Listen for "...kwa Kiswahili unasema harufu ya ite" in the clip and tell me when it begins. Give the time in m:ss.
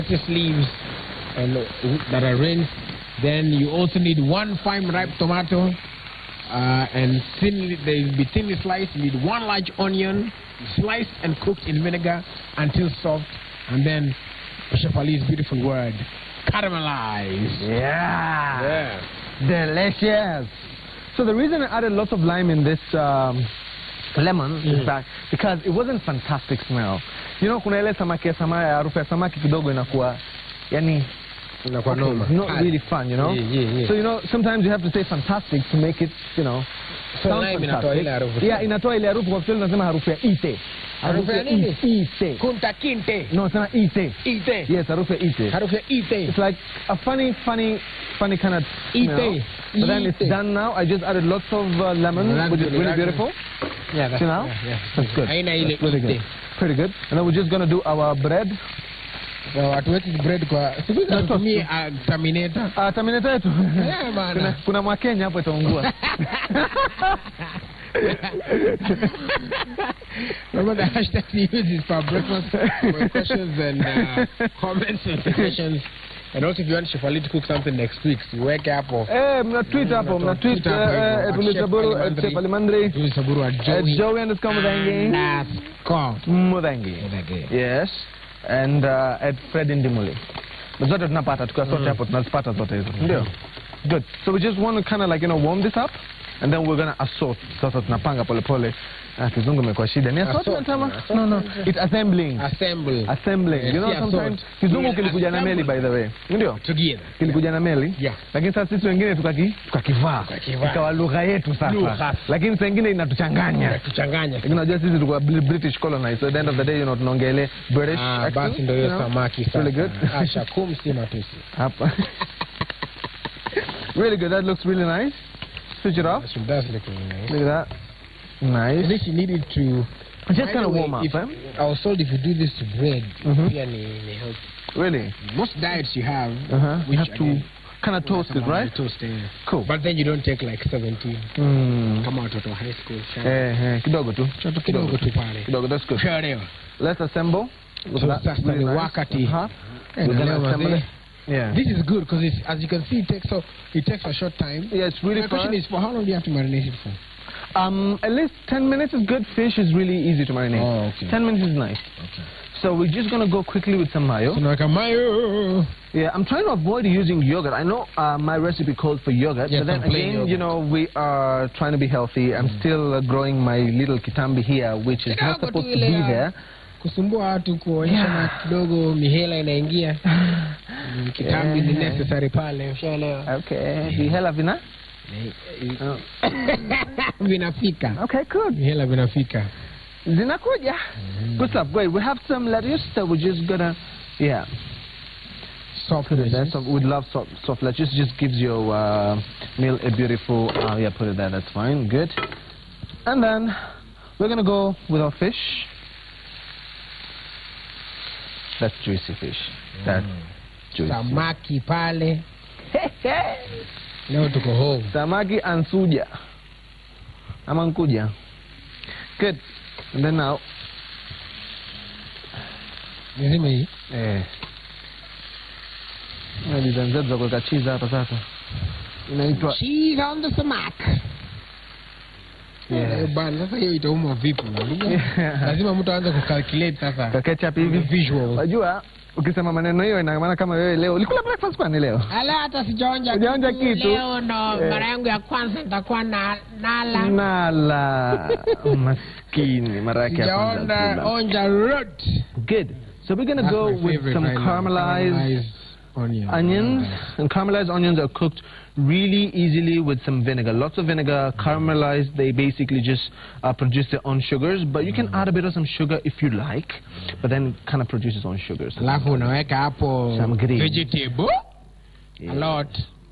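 0:39.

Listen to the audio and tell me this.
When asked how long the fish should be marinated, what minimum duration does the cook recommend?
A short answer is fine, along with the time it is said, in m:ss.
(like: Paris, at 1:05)
10 minutes, at 2:38.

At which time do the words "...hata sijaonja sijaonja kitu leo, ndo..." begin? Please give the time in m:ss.
4:02.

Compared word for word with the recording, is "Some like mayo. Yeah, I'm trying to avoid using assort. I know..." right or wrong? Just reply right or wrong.
wrong.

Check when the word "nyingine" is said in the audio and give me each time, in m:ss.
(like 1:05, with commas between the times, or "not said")
1:52.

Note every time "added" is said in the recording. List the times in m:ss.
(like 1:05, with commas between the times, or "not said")
0:21, 0:51.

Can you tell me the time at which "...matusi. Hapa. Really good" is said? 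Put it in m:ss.
2:00.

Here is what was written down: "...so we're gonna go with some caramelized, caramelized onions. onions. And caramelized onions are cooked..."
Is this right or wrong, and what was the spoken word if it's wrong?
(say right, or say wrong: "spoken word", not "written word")
right.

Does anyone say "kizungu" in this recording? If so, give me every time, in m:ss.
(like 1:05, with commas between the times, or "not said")
1:39, 1:44.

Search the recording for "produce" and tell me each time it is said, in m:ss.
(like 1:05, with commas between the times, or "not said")
4:23, 4:27.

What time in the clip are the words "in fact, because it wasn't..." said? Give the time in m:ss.
0:24.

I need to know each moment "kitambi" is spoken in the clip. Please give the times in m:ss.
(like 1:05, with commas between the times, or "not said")
2:53, 3:01.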